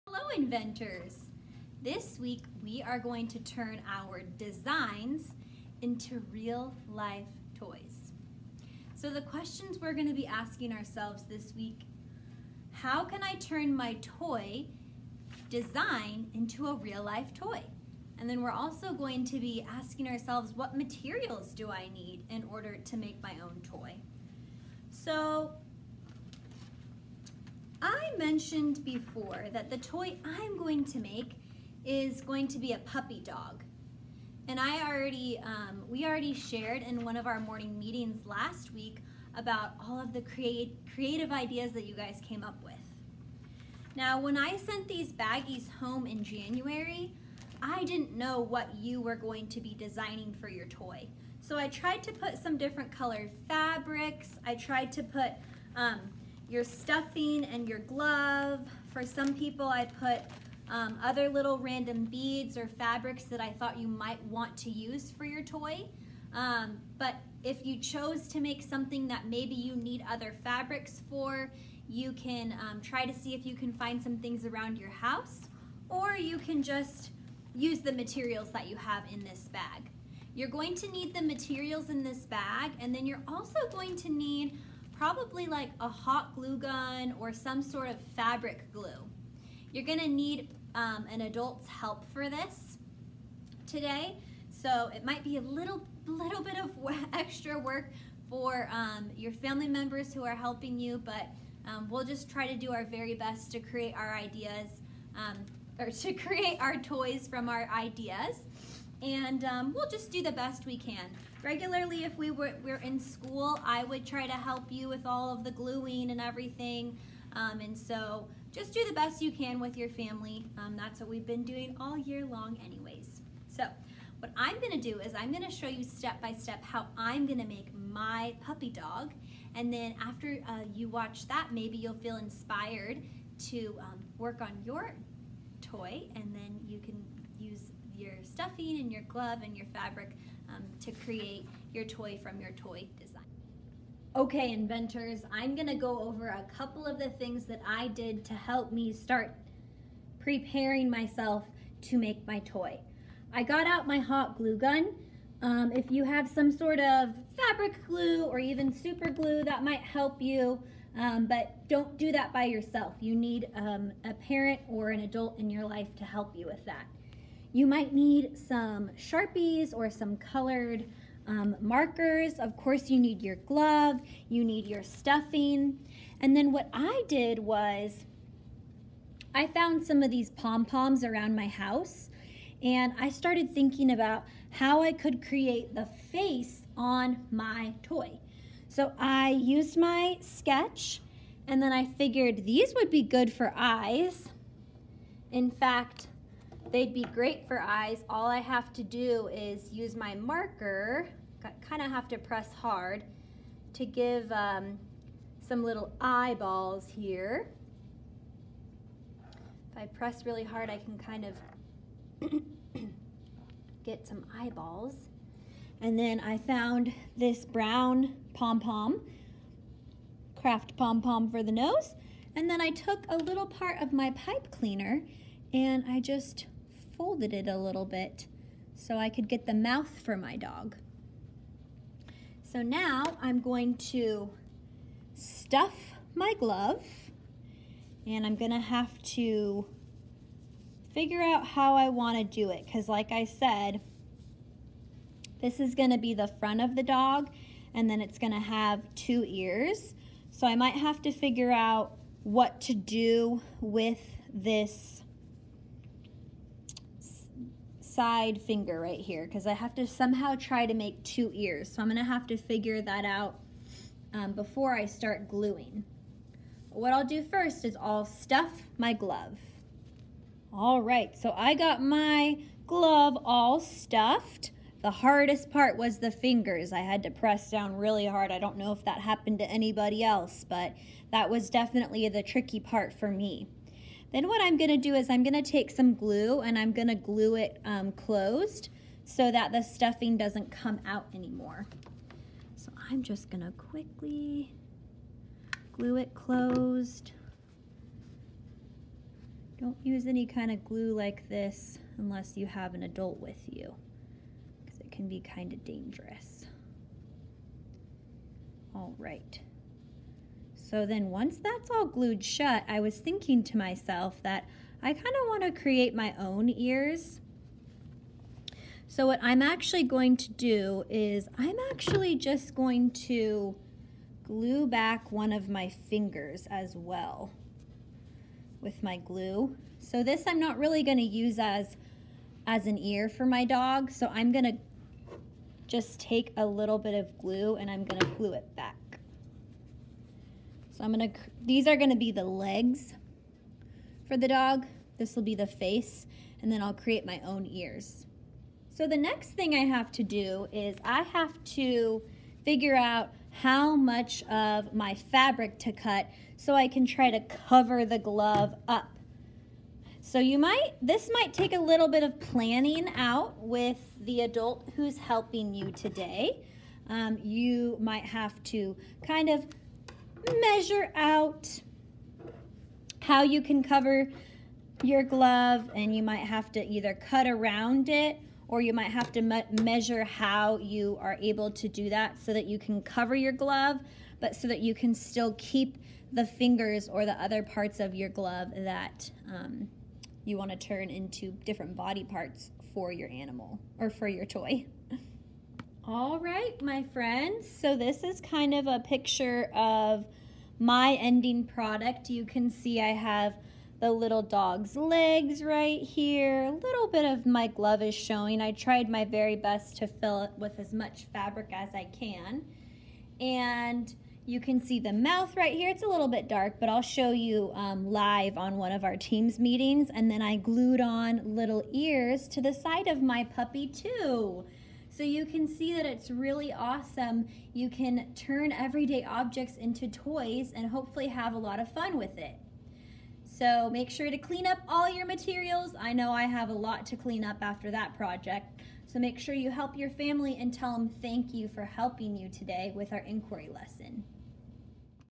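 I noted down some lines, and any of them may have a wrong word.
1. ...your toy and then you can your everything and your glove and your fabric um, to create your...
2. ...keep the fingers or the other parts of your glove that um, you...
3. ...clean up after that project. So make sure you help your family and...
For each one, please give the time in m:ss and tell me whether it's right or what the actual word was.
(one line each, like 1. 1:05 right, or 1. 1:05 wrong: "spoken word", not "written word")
1. 2:14 wrong: "stuffing", not "everything"
2. 6:25 right
3. 7:16 right.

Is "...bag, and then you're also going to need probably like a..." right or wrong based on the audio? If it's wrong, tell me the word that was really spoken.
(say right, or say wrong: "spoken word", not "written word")
right.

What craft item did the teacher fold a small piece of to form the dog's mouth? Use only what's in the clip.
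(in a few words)
Pipe cleaner.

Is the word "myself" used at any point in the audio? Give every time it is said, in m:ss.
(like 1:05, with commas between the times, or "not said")
2:30, 5:13.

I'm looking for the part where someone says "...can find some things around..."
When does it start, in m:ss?
1:13.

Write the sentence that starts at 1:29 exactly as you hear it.
You're gonna need um, an adult's help for this today.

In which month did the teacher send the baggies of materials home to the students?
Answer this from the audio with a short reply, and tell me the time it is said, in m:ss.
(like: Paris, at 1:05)
January, at 0:46.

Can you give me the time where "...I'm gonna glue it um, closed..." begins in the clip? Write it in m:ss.
4:46.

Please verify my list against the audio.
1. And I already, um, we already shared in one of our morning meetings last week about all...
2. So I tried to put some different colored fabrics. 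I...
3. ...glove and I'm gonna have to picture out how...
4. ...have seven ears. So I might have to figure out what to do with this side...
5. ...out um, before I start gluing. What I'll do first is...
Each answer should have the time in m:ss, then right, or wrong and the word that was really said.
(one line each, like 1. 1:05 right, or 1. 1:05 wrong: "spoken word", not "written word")
1. 0:34 right
2. 0:51 right
3. 3:56 wrong: "figure", not "picture"
4. 4:08 wrong: "two", not "seven"
5. 4:23 right.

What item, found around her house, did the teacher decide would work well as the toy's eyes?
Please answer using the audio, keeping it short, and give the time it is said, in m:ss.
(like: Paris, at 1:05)
Pom-poms, at 3:00.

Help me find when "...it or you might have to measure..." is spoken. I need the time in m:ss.
6:17.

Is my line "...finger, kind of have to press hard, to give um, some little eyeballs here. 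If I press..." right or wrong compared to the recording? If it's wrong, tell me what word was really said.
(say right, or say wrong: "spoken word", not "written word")
wrong: "marker", not "finger".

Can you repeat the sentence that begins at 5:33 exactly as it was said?
So I'm going to just take a little bit of glue and I'm going to glue it back.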